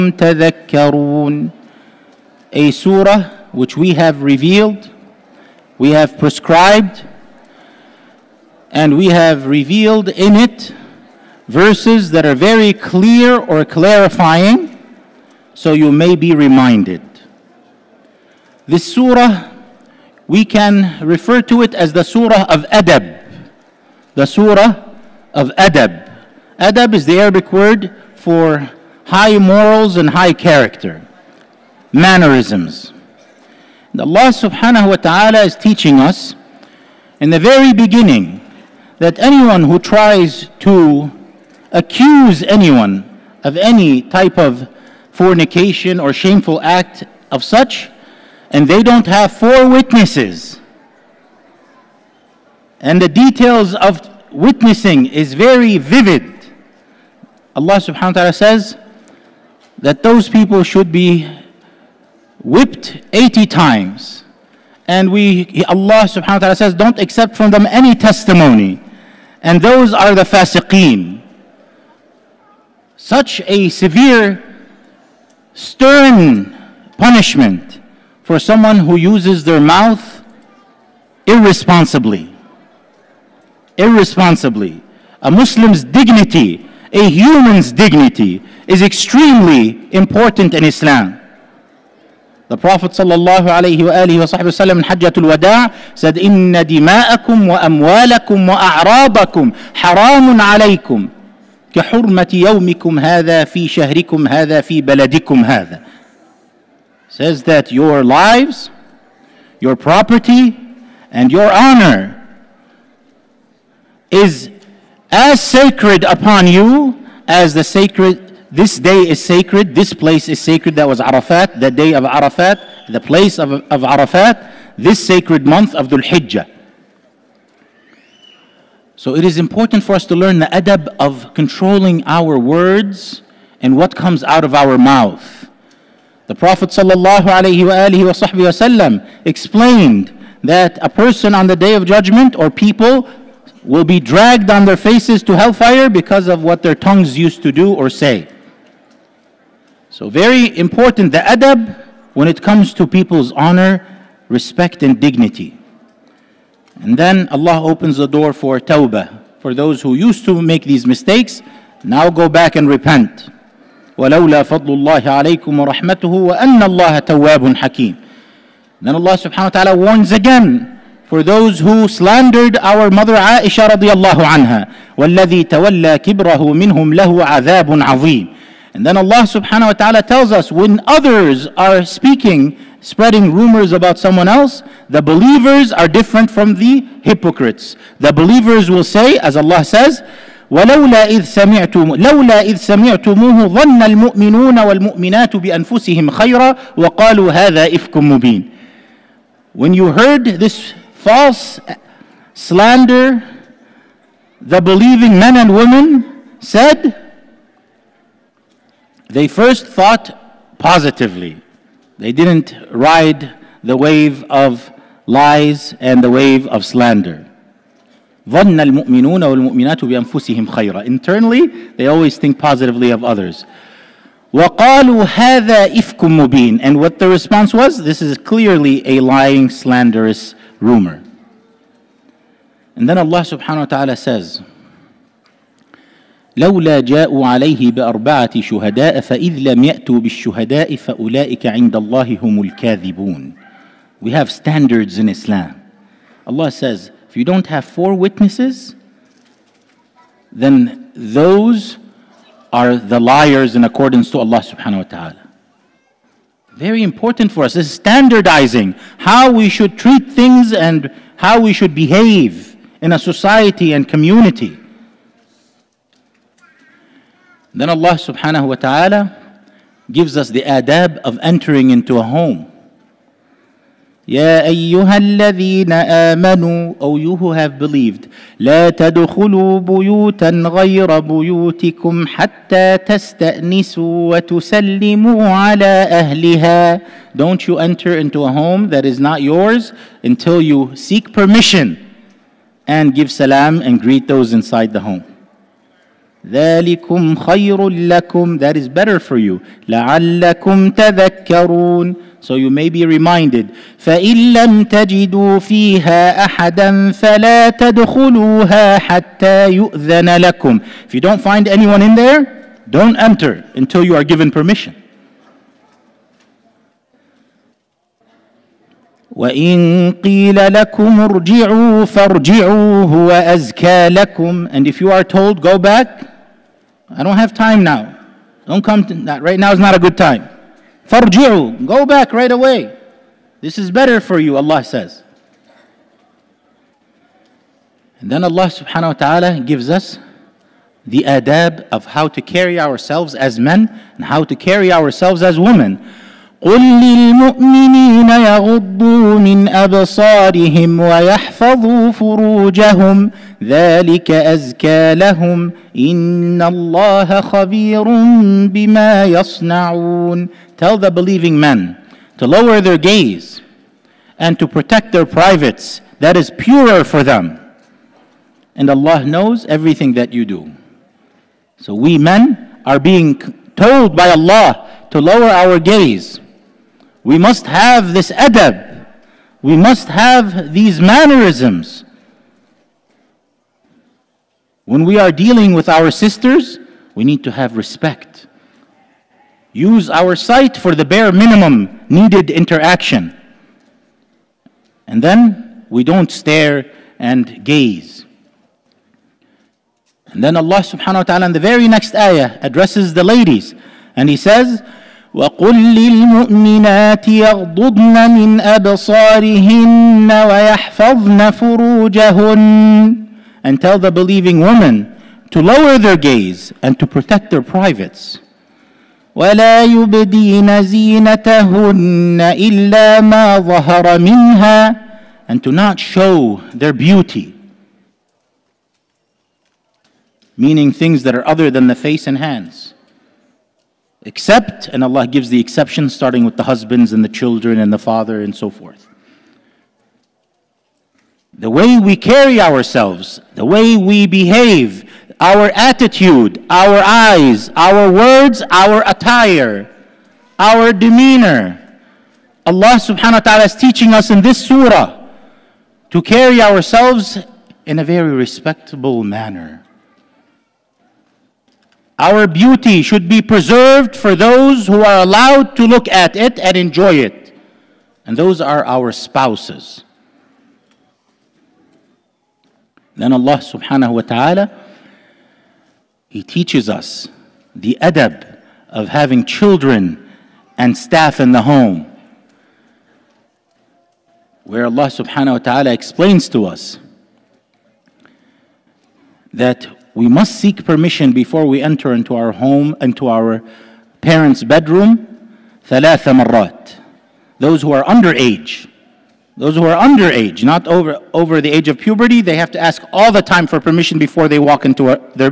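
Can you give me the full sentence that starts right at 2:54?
والذي تولى كبره منهم له عذاب عظيم.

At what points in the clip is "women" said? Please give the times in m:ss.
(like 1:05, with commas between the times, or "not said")
3:25, 5:45, 6:54.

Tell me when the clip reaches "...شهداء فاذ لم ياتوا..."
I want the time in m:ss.
3:58.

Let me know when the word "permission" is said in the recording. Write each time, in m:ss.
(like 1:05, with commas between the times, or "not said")
4:51, 5:14, 8:10, 8:23.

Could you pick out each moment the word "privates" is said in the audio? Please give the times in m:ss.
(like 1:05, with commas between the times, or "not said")
6:05, 6:57.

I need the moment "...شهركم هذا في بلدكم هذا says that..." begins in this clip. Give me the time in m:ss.
1:43.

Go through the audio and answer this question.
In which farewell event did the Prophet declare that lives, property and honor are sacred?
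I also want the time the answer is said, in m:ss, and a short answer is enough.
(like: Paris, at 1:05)
Hajjatul Wada', at 1:34.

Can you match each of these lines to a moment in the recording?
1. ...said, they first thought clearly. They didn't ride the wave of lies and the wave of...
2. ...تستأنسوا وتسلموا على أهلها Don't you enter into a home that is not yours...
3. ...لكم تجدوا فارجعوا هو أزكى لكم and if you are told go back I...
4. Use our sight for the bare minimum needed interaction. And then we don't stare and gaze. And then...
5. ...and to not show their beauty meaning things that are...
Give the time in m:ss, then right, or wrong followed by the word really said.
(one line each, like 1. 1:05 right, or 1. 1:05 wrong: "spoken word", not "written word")
1. 3:26 wrong: "positively", not "clearly"
2. 4:42 right
3. 5:20 wrong: "ارجعوا", not "تجدوا"
4. 6:29 right
5. 7:05 right.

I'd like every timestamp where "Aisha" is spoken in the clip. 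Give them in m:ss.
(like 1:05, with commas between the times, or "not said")
2:53.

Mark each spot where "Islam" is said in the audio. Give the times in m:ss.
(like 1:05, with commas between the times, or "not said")
1:30, 4:05.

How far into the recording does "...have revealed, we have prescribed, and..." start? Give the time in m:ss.
0:03.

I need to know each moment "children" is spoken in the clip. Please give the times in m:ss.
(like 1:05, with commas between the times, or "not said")
7:17, 7:59.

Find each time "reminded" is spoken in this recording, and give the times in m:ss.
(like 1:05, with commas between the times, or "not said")
0:16, 5:02.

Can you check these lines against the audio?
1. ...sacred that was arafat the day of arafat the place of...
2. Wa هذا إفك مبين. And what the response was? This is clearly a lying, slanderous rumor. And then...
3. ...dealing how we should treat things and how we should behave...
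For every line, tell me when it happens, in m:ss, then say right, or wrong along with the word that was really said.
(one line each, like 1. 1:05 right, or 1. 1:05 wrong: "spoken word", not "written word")
1. 2:00 right
2. 3:44 right
3. 4:17 wrong: "standardizing", not "dealing".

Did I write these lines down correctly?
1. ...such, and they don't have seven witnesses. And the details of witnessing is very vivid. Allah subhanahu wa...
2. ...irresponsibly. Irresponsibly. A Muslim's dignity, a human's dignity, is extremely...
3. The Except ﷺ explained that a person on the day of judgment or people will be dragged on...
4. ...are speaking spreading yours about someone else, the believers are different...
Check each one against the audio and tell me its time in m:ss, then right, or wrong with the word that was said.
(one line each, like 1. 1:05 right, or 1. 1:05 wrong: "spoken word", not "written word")
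1. 0:47 wrong: "four", not "seven"
2. 1:21 right
3. 2:16 wrong: "Prophet", not "Except"
4. 3:01 wrong: "rumors", not "yours".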